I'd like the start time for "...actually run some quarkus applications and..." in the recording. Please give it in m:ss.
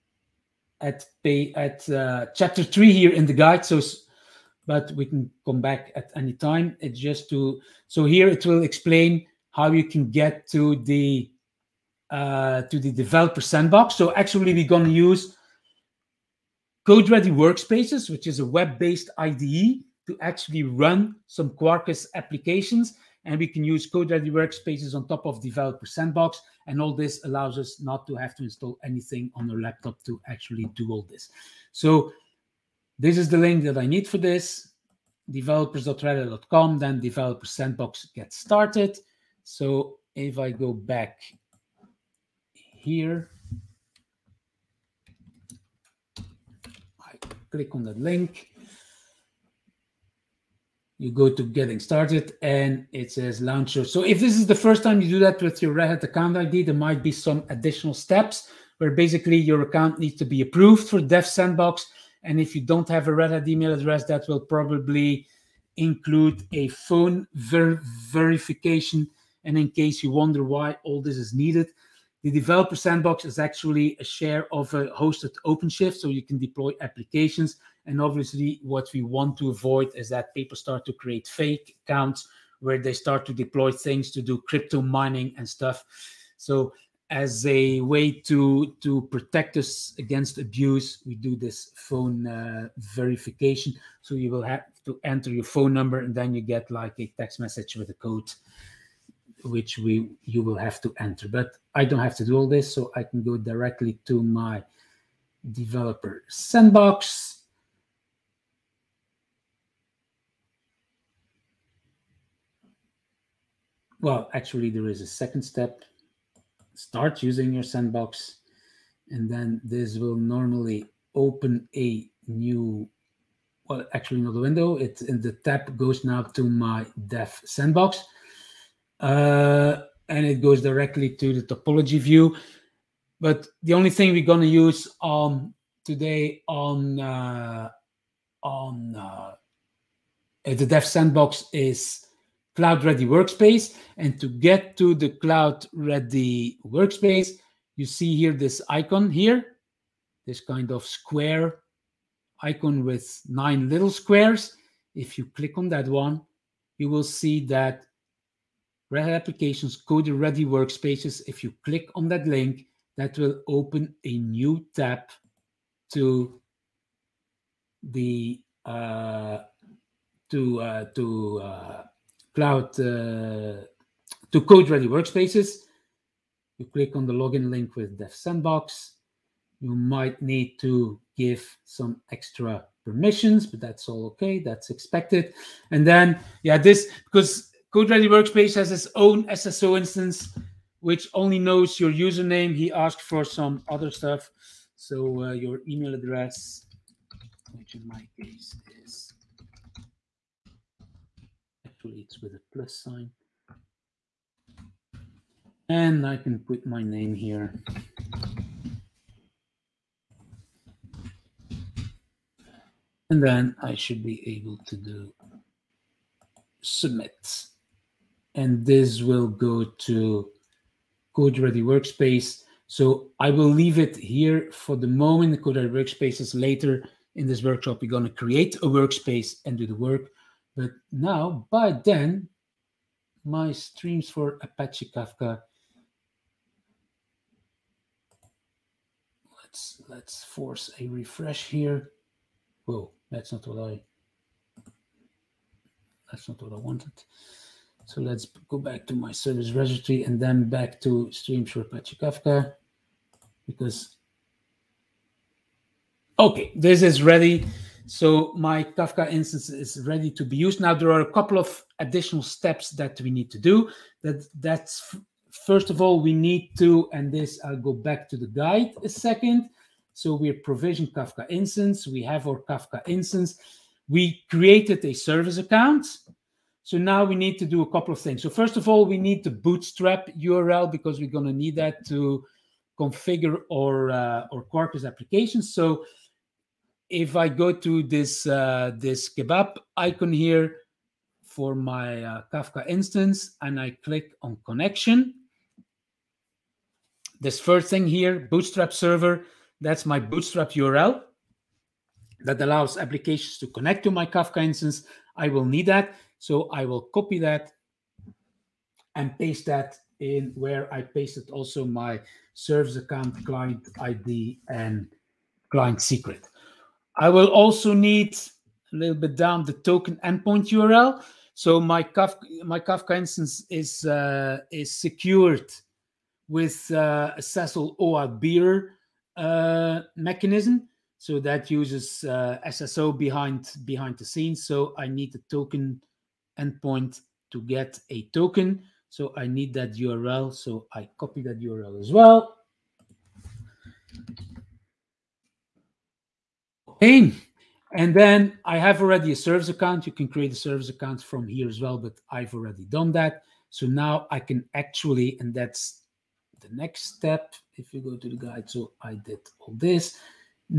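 0:20.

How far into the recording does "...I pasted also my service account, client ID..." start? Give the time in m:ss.
5:10.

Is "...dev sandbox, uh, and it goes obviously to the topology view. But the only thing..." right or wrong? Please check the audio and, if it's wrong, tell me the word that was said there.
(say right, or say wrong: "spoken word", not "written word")
wrong: "directly", not "obviously".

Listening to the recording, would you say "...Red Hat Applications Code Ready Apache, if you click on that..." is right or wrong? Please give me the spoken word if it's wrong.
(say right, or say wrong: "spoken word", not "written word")
wrong: "Workspaces", not "Apache".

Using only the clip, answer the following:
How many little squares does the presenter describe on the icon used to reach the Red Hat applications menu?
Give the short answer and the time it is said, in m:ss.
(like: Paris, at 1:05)
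9, at 2:33.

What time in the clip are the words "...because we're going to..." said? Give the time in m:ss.
4:40.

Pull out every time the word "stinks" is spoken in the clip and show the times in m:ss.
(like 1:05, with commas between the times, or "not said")
not said.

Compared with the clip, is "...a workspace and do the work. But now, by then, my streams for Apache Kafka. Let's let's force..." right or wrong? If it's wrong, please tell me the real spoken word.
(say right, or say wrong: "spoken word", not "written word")
right.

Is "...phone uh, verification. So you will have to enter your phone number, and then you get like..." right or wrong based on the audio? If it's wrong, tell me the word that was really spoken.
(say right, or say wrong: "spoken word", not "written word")
right.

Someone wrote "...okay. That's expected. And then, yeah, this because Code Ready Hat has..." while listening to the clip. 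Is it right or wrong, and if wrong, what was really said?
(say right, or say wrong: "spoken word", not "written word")
wrong: "Workspace", not "Hat".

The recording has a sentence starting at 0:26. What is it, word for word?
And all this allows us not to have to install anything on our laptop to actually do all this.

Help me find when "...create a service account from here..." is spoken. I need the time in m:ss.
5:50.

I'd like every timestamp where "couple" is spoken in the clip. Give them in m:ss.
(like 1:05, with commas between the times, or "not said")
4:21, 4:37.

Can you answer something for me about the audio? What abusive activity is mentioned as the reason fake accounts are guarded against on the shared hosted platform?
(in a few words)
Crypto mining.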